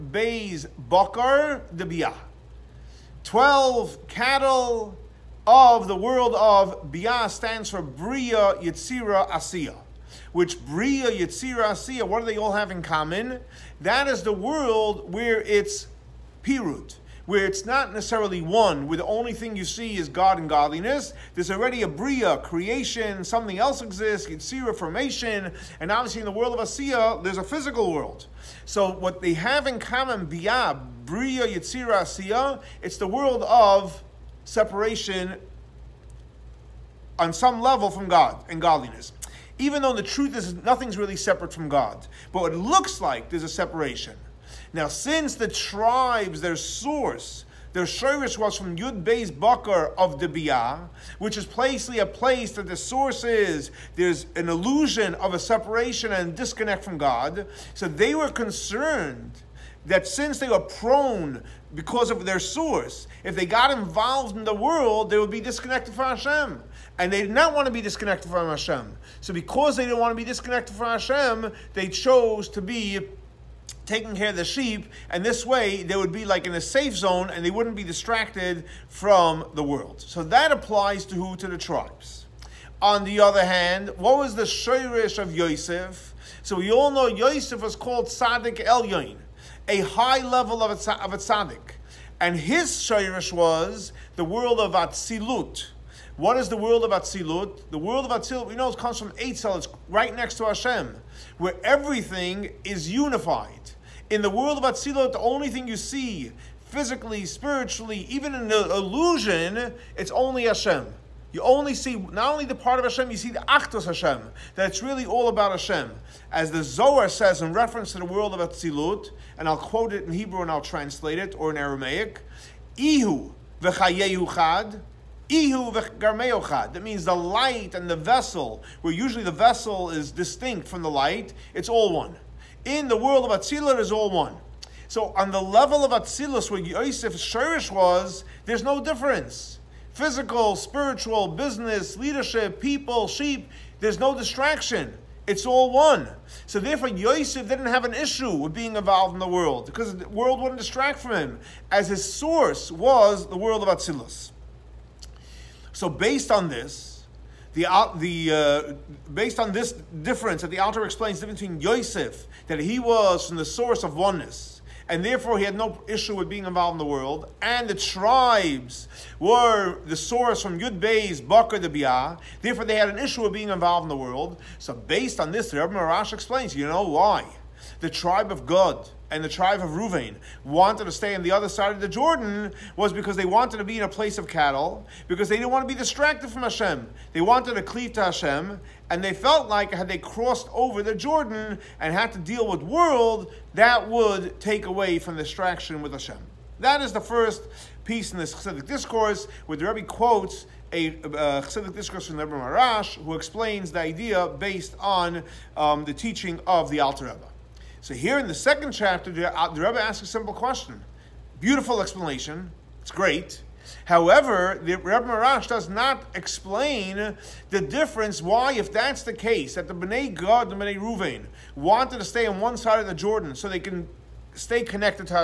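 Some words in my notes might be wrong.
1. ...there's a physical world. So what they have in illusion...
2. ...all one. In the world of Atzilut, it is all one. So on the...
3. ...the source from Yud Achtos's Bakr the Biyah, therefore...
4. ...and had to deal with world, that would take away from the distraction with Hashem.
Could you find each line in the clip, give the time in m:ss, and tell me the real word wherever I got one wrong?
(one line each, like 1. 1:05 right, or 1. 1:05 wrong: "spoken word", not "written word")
1. 0:27 wrong: "common", not "illusion"
2. 2:11 right
3. 2:49 wrong: "Bey", not "Achtos"
4. 3:11 right.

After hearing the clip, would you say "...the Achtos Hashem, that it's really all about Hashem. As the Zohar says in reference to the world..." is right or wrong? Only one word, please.
right.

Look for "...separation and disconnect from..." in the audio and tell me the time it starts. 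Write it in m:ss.
0:55.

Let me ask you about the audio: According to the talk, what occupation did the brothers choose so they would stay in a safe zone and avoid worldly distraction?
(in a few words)
Taking care of the sheep.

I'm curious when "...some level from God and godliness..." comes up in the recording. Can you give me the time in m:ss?
0:37.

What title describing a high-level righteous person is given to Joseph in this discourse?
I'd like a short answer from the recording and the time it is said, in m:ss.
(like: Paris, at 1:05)
Tzaddik Elyon, at 1:28.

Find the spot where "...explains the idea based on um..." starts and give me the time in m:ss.
3:23.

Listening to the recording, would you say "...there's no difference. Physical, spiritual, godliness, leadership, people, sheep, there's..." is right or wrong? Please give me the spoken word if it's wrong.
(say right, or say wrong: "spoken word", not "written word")
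wrong: "business", not "godliness".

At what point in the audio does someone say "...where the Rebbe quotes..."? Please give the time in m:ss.
3:19.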